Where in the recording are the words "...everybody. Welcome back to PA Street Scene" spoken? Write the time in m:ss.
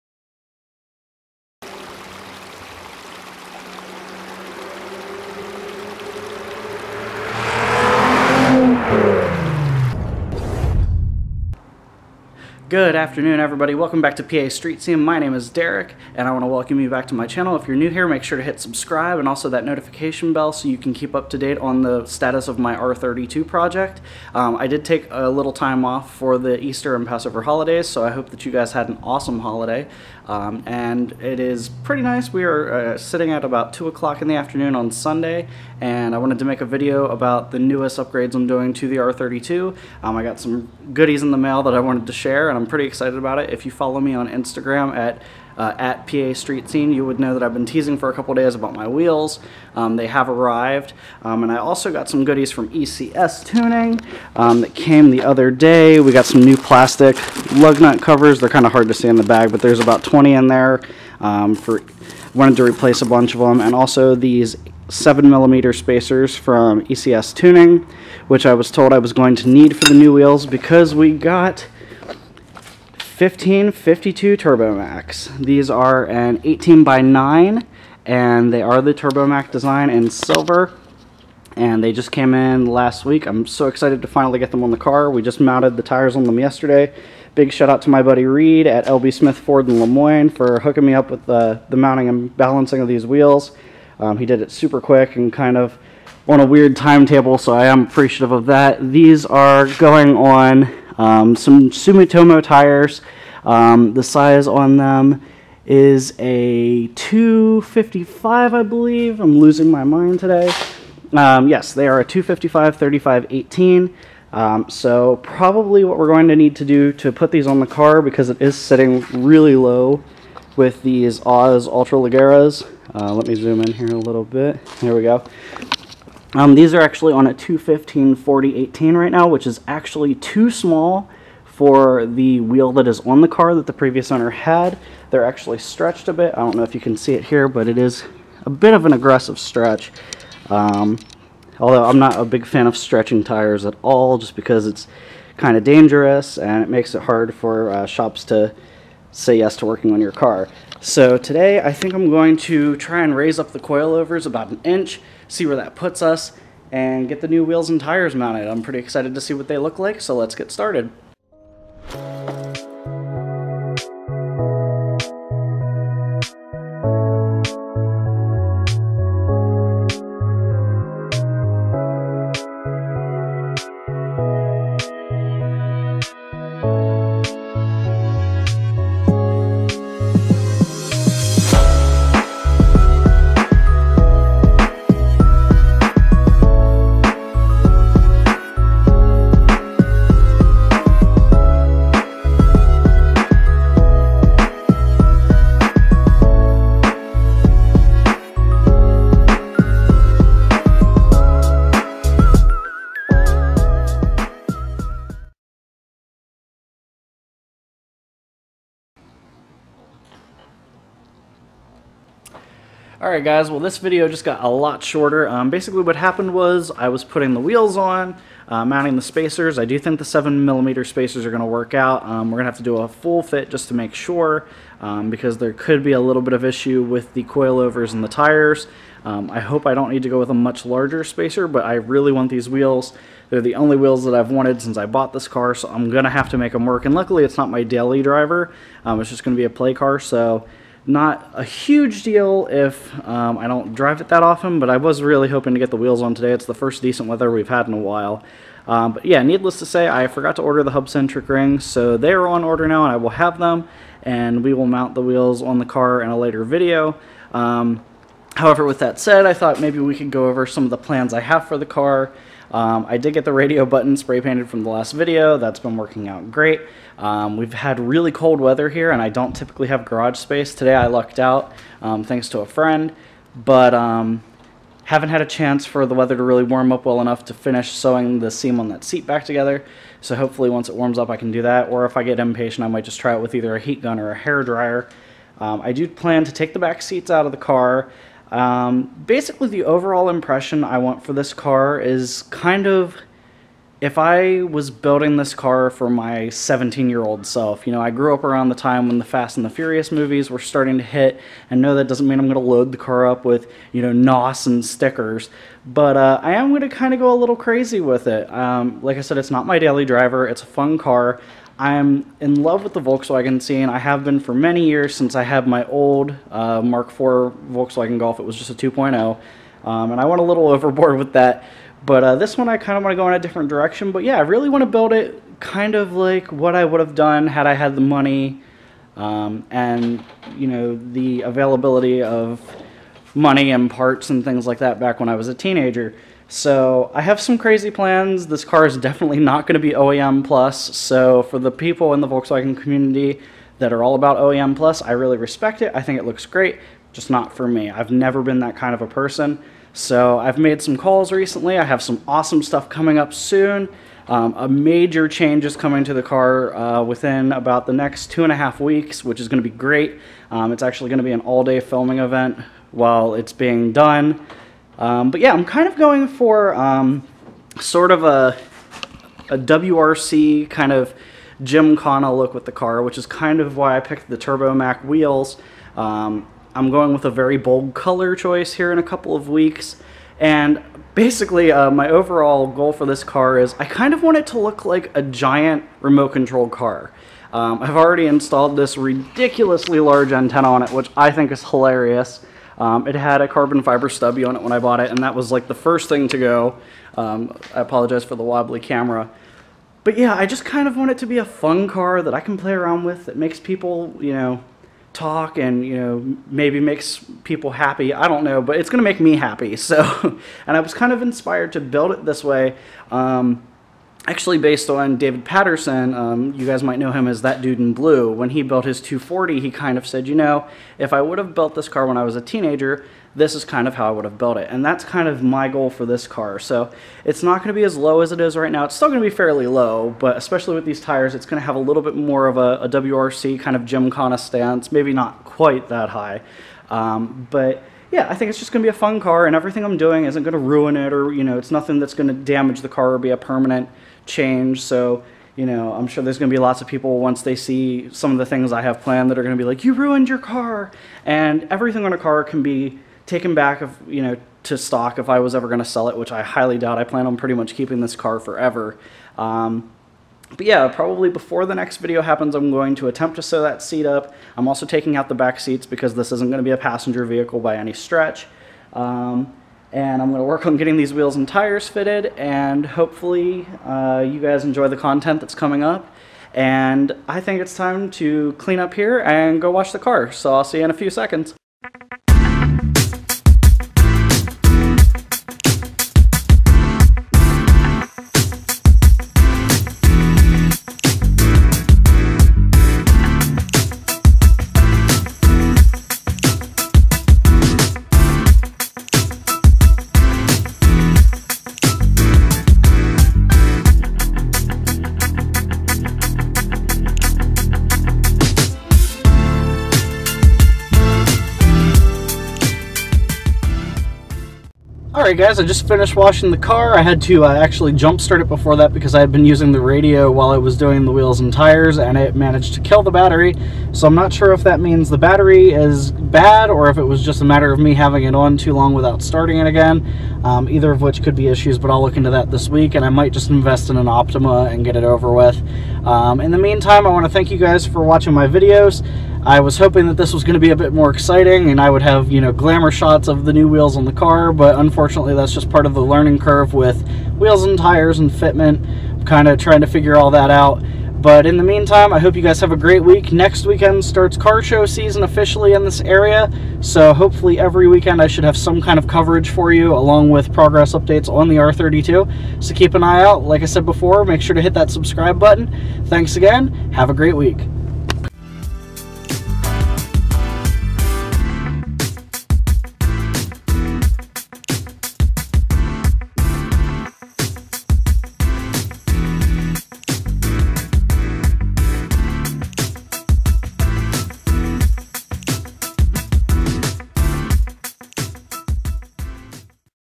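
0:13.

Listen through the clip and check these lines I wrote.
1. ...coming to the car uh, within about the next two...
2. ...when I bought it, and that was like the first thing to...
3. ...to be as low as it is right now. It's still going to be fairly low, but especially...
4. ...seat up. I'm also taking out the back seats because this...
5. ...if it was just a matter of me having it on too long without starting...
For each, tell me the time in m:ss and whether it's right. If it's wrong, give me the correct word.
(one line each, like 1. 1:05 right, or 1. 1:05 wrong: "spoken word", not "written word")
1. 5:55 right
2. 6:34 right
3. 7:07 right
4. 7:43 right
5. 8:46 right.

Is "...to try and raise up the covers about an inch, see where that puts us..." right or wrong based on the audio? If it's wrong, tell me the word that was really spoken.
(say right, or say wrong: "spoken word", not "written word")
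wrong: "coilovers", not "covers".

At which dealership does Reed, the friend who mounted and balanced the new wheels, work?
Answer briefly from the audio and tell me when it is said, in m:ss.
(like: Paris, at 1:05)
LB Smith Ford, at 1:28.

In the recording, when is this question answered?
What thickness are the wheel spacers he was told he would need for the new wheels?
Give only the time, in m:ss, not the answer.
1:04.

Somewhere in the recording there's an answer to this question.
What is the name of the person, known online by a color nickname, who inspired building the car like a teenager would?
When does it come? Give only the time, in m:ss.
6:54.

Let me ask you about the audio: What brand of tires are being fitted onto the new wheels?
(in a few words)
Sumitomo.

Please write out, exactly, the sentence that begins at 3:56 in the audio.
And luckily it's not my daily driver.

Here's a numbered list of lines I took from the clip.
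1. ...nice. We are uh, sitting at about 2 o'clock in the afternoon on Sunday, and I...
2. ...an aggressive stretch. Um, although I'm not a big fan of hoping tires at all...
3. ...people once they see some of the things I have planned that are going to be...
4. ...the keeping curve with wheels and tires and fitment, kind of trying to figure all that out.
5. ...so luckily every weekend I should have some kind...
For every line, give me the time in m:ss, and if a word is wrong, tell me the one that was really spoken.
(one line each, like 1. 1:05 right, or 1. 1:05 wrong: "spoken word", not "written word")
1. 0:32 right
2. 2:18 wrong: "stretching", not "hoping"
3. 7:26 right
4. 9:05 wrong: "learning", not "keeping"
5. 9:16 wrong: "hopefully", not "luckily".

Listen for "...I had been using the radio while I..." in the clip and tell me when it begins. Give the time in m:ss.
8:38.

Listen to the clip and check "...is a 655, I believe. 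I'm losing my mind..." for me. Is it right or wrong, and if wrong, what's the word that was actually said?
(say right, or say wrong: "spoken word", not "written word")
wrong: "255", not "655".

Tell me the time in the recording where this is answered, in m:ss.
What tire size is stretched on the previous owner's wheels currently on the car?
2:07.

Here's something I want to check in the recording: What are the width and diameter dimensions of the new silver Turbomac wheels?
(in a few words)
18 by 9.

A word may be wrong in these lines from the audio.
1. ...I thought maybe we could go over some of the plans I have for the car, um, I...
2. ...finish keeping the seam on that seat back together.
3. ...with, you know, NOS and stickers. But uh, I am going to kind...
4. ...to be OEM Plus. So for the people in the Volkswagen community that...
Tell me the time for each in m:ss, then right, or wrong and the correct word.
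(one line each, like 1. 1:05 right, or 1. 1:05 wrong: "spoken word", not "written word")
1. 4:19 right
2. 4:37 wrong: "sewing", not "keeping"
3. 5:03 right
4. 5:39 right.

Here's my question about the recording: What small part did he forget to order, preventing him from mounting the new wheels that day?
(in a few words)
hub-centric rings.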